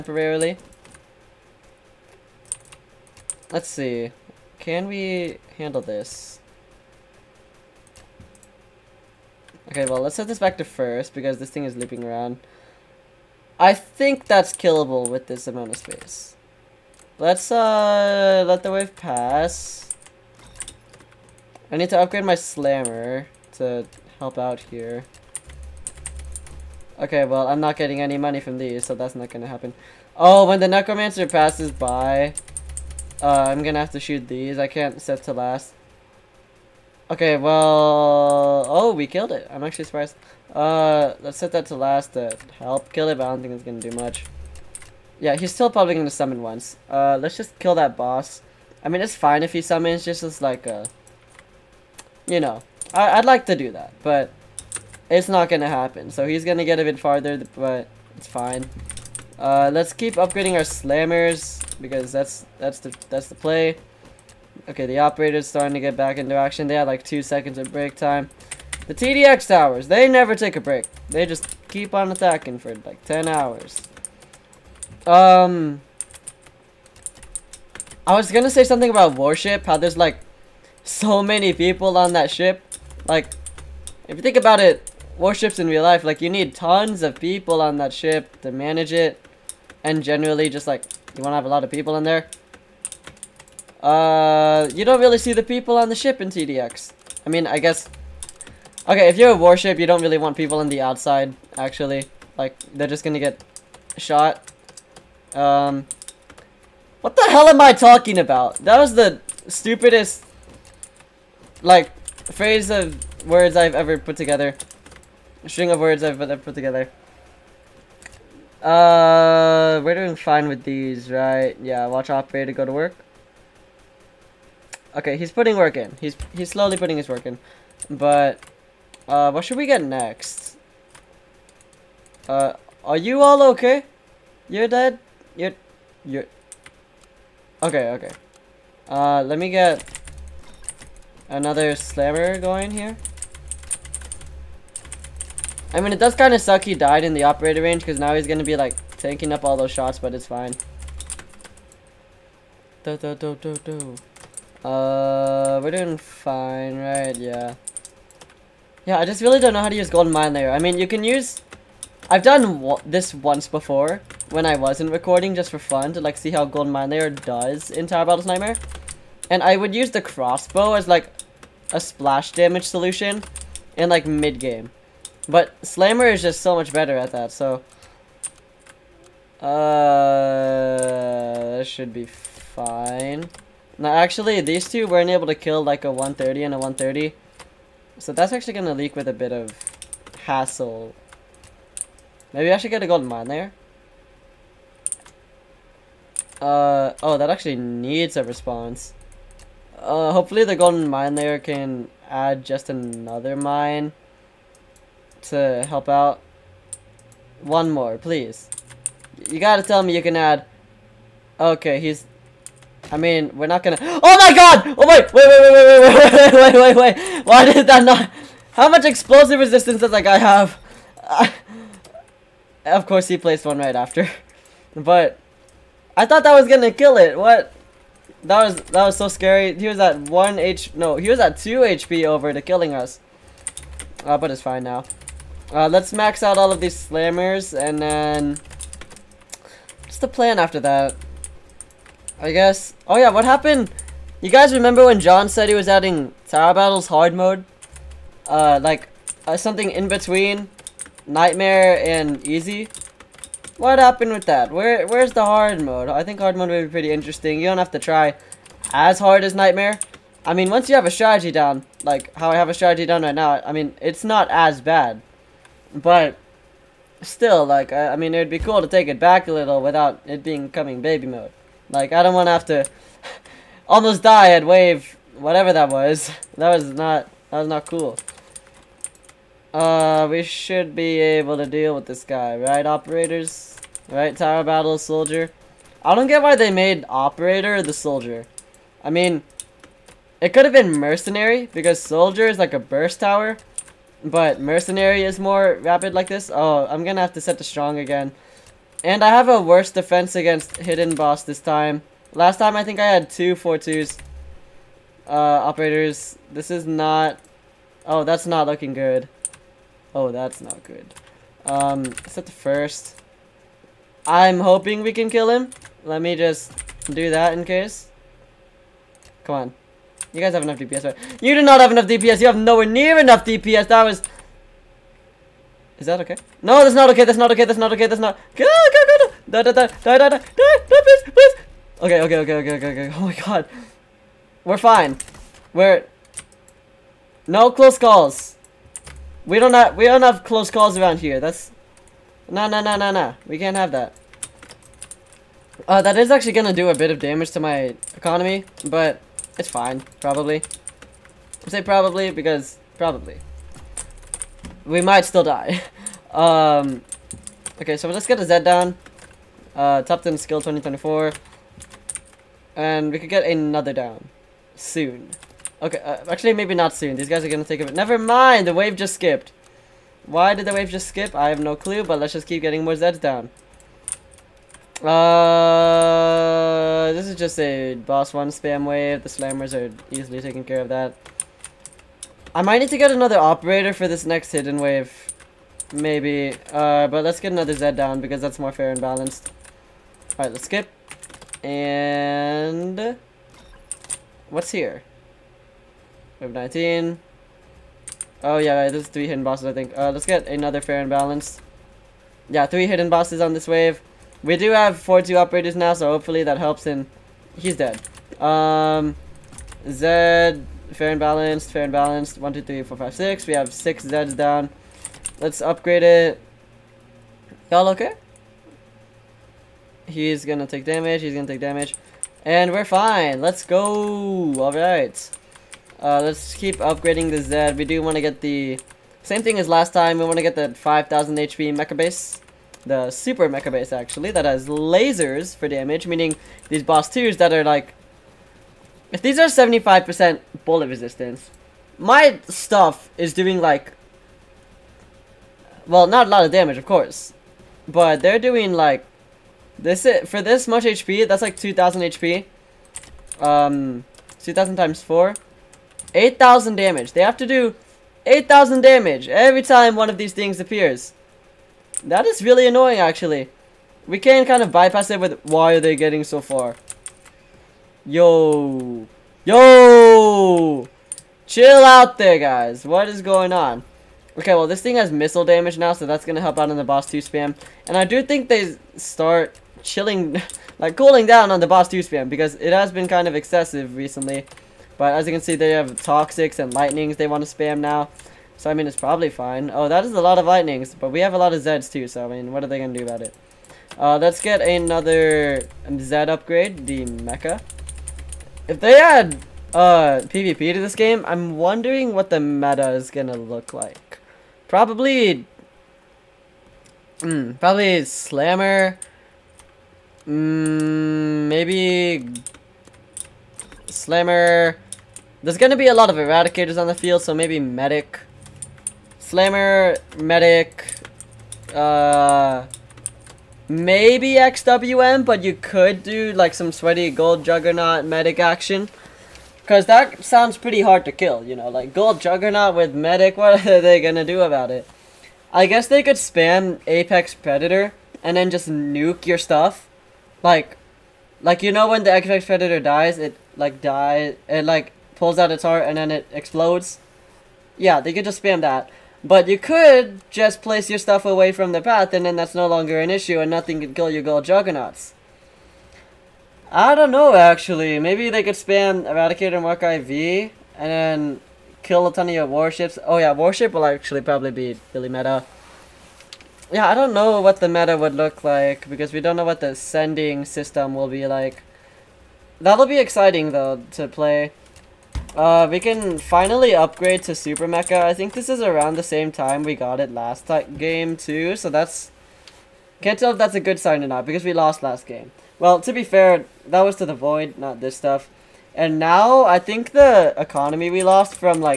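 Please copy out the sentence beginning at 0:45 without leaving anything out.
Yeah, he's still probably gonna summon once.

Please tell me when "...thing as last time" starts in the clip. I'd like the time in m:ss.
7:09.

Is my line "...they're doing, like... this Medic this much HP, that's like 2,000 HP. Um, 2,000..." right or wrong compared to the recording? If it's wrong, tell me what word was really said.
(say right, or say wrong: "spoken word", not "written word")
wrong: "For", not "Medic".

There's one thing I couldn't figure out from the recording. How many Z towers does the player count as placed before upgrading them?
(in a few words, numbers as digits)
6.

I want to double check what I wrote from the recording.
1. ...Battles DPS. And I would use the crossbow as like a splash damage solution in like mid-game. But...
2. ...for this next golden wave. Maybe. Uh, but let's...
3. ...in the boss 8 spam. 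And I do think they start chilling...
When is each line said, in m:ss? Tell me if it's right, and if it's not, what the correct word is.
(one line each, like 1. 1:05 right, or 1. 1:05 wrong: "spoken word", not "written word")
1. 2:48 wrong: "Nightmare", not "DPS"
2. 6:23 wrong: "hidden", not "golden"
3. 7:56 wrong: "2", not "8".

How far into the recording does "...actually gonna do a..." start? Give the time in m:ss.
5:46.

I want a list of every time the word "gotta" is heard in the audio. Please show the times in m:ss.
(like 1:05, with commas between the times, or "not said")
3:29.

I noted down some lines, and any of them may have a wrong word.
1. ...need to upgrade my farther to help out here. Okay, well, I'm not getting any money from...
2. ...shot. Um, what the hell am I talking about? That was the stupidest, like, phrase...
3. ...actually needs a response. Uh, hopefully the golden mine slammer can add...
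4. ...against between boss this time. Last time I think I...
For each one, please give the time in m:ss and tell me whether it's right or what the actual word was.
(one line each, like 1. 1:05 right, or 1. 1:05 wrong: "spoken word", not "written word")
1. 0:21 wrong: "slammer", not "farther"
2. 1:43 right
3. 3:17 wrong: "layer", not "slammer"
4. 5:00 wrong: "hidden", not "between".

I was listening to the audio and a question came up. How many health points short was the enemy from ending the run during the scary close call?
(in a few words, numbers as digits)
2.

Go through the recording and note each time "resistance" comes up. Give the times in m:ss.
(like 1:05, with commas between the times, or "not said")
3:39, 7:20.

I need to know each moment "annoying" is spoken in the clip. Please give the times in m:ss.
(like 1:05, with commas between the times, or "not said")
7:42.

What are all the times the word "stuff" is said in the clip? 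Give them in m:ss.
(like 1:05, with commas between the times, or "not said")
7:22, 8:59, 9:10, 9:47.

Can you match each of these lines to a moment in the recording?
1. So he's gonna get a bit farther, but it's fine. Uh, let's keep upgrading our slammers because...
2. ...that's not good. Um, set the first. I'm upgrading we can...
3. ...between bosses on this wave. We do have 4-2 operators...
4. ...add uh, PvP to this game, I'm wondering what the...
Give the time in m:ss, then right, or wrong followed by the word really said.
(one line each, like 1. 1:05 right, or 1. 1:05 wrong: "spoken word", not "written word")
1. 0:56 right
2. 5:10 wrong: "hoping", not "upgrading"
3. 6:42 wrong: "hidden", not "between"
4. 8:18 right.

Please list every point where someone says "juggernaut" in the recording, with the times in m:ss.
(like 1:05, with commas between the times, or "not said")
8:47, 8:51, 9:14.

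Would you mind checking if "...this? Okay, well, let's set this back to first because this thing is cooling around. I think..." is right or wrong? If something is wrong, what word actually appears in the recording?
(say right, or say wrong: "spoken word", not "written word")
wrong: "looping", not "cooling".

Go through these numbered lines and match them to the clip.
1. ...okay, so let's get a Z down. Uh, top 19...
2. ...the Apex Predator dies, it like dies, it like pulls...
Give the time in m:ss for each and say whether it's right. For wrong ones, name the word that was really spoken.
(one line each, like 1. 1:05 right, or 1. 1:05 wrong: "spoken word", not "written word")
1. 5:57 wrong: "10", not "19"
2. 9:01 right.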